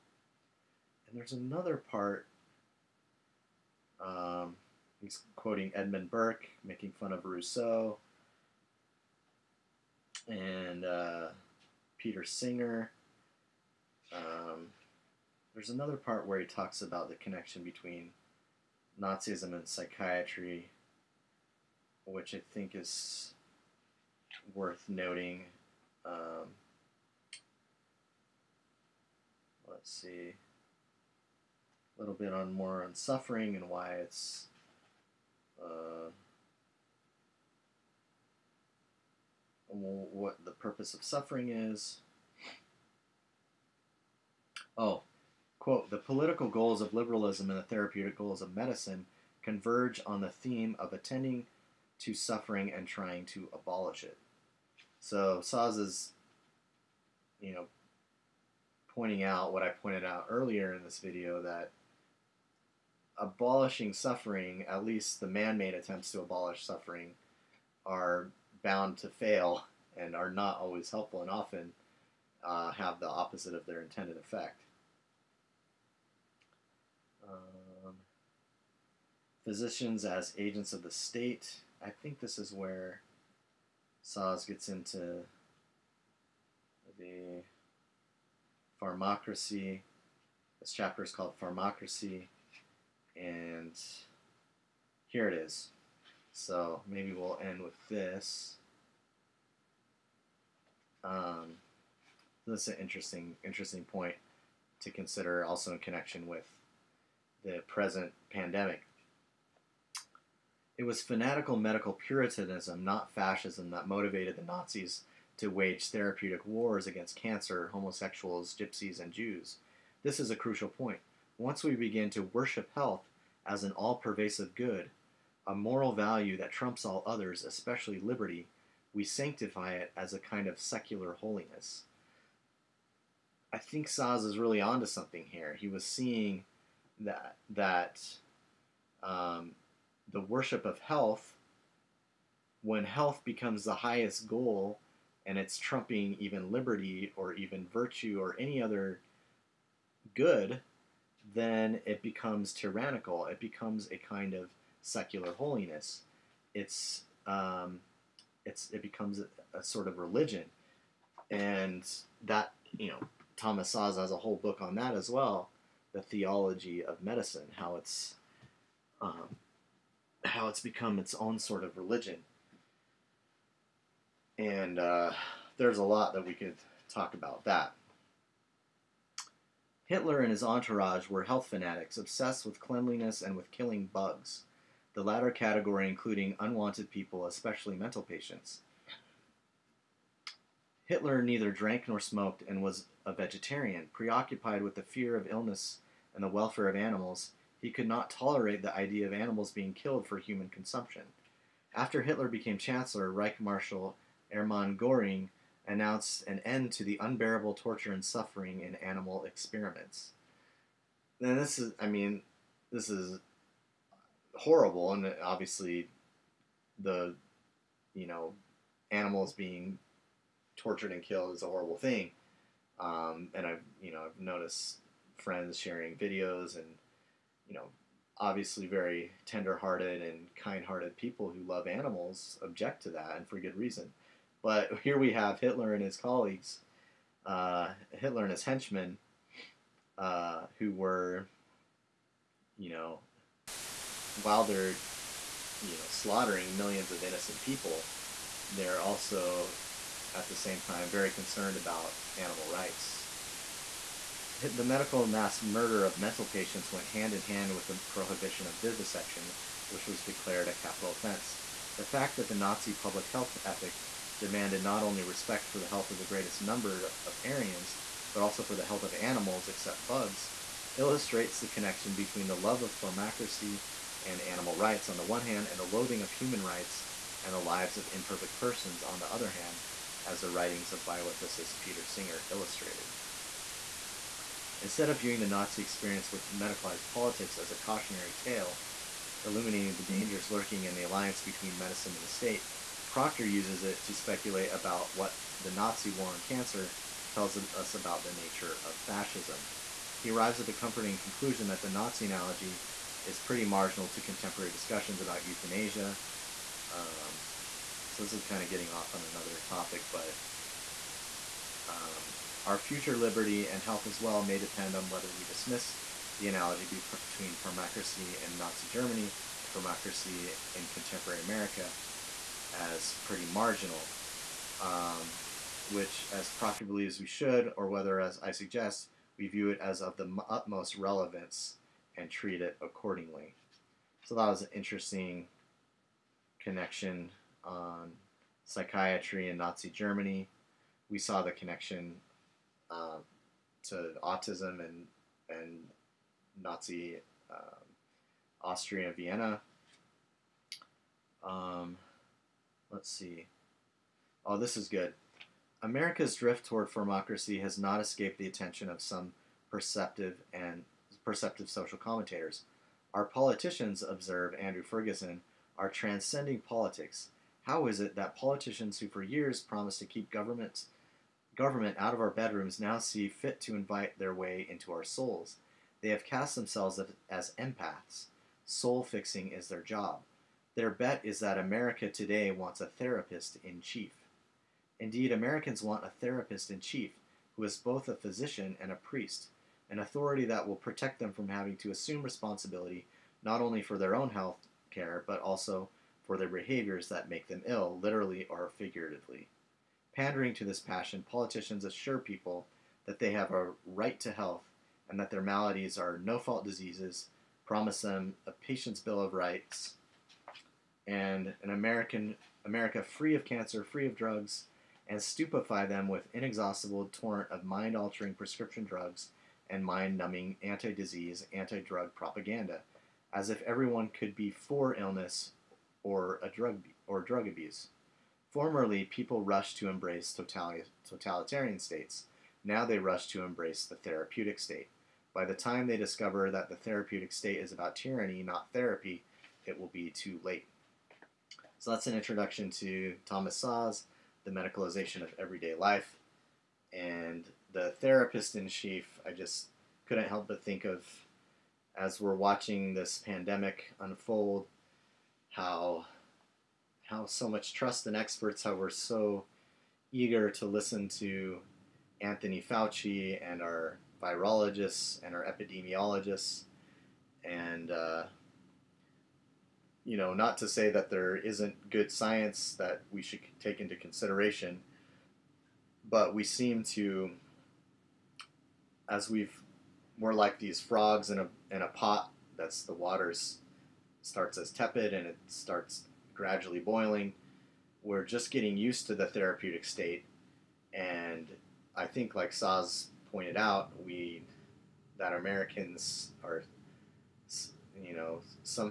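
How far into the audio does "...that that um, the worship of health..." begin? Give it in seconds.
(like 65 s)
136 s.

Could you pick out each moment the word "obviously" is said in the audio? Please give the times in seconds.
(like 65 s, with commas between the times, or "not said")
215 s, 228 s.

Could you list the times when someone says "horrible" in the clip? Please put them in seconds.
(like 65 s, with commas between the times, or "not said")
214 s, 221 s.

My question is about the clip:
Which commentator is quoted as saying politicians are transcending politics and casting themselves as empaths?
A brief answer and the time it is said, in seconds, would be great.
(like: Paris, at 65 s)
Andrew Ferguson, at 364 s.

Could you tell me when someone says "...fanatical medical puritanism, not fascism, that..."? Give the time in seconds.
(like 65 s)
111 s.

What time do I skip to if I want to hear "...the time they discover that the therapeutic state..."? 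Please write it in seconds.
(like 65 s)
435 s.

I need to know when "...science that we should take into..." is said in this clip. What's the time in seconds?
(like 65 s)
471 s.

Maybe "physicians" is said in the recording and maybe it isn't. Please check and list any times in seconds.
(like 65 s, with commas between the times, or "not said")
79 s, 387 s.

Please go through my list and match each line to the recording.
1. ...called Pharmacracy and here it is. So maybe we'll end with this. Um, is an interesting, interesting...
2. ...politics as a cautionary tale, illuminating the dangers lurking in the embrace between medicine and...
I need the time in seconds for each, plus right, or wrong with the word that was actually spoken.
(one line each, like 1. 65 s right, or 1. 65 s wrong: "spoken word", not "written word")
1. 91 s right
2. 286 s wrong: "alliance", not "embrace".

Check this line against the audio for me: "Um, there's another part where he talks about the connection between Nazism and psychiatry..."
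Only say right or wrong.
right.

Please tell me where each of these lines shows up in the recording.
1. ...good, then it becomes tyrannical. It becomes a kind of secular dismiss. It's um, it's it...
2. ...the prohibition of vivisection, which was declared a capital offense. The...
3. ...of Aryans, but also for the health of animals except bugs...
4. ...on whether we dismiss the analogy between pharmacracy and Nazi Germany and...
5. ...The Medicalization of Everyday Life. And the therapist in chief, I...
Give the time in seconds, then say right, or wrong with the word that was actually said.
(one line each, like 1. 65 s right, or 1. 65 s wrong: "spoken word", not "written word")
1. 150 s wrong: "holiness", not "dismiss"
2. 257 s right
3. 267 s right
4. 314 s right
5. 444 s right.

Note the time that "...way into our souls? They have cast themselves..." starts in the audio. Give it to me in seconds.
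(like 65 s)
374 s.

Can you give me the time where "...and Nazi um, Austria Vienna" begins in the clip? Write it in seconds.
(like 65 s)
345 s.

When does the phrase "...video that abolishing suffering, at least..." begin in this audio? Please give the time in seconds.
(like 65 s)
60 s.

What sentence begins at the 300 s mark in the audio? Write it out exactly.
He arrives at the comforting conclusion that the Nazi analogy is pretty marginal to contemporary discussions about euthanasia.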